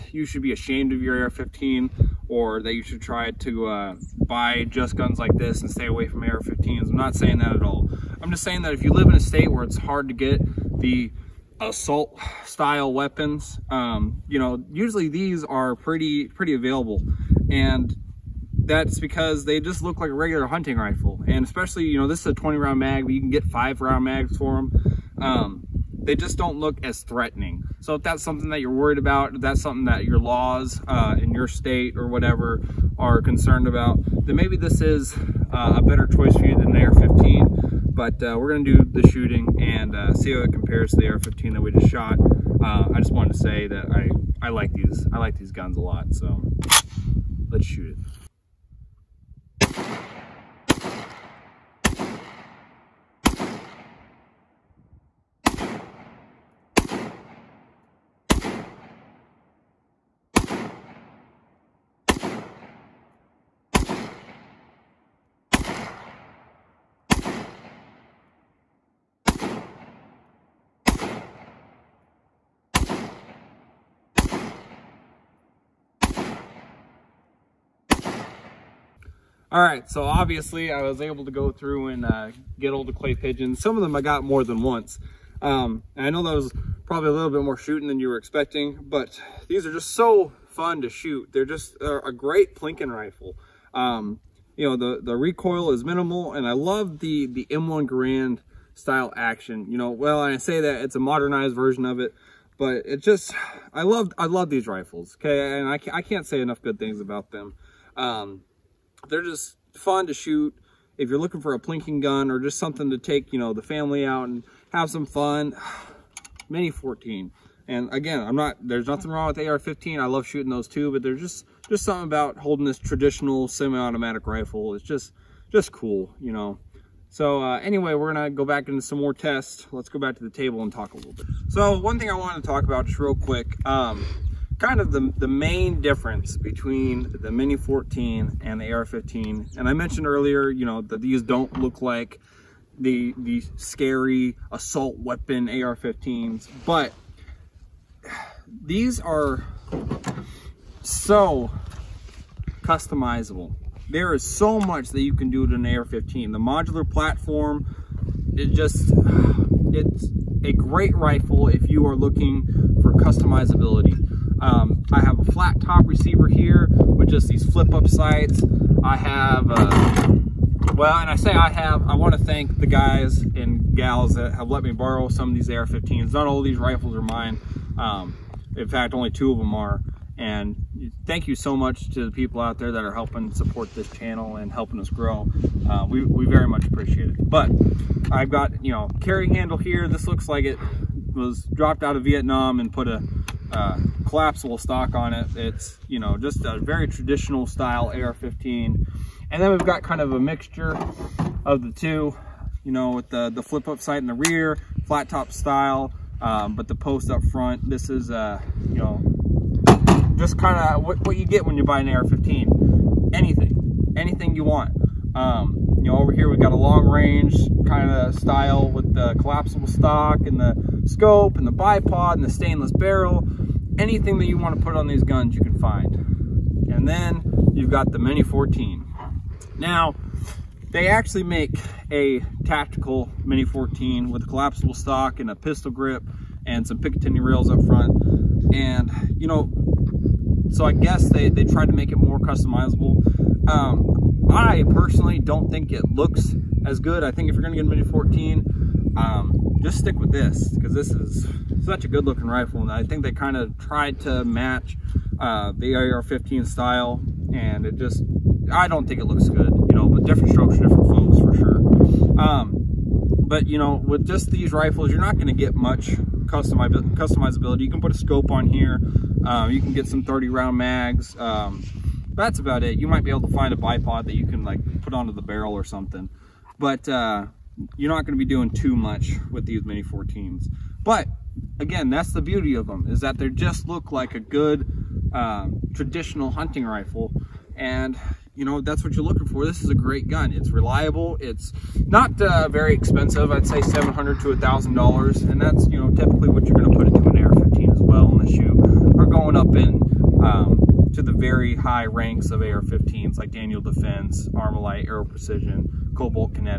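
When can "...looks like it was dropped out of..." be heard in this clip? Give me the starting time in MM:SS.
03:10.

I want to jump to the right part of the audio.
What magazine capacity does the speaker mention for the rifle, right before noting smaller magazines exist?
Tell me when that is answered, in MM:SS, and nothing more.
00:22.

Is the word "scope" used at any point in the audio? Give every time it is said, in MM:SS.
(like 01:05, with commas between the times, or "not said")
03:40, 04:27.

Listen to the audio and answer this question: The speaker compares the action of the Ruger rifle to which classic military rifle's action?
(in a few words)
M1 Garand.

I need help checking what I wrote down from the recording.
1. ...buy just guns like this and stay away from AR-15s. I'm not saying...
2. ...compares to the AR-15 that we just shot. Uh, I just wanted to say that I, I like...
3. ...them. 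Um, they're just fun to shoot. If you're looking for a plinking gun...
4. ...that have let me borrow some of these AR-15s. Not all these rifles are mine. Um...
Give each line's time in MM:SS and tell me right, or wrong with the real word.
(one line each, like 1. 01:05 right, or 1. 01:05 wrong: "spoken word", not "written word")
1. 00:04 right
2. 00:40 right
3. 01:47 right
4. 02:54 right.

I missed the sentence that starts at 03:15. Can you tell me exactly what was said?
It's, you know, just a very traditional style AR-15.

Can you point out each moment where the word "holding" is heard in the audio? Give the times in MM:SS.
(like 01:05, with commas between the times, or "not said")
02:02.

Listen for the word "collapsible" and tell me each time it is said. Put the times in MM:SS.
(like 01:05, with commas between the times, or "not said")
03:14, 03:39, 03:54.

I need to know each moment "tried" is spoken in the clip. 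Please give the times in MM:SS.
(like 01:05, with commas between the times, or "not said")
04:01, 04:13.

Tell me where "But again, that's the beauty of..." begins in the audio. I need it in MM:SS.
04:40.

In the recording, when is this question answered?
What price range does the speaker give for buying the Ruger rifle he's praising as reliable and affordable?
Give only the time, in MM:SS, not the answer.
04:53.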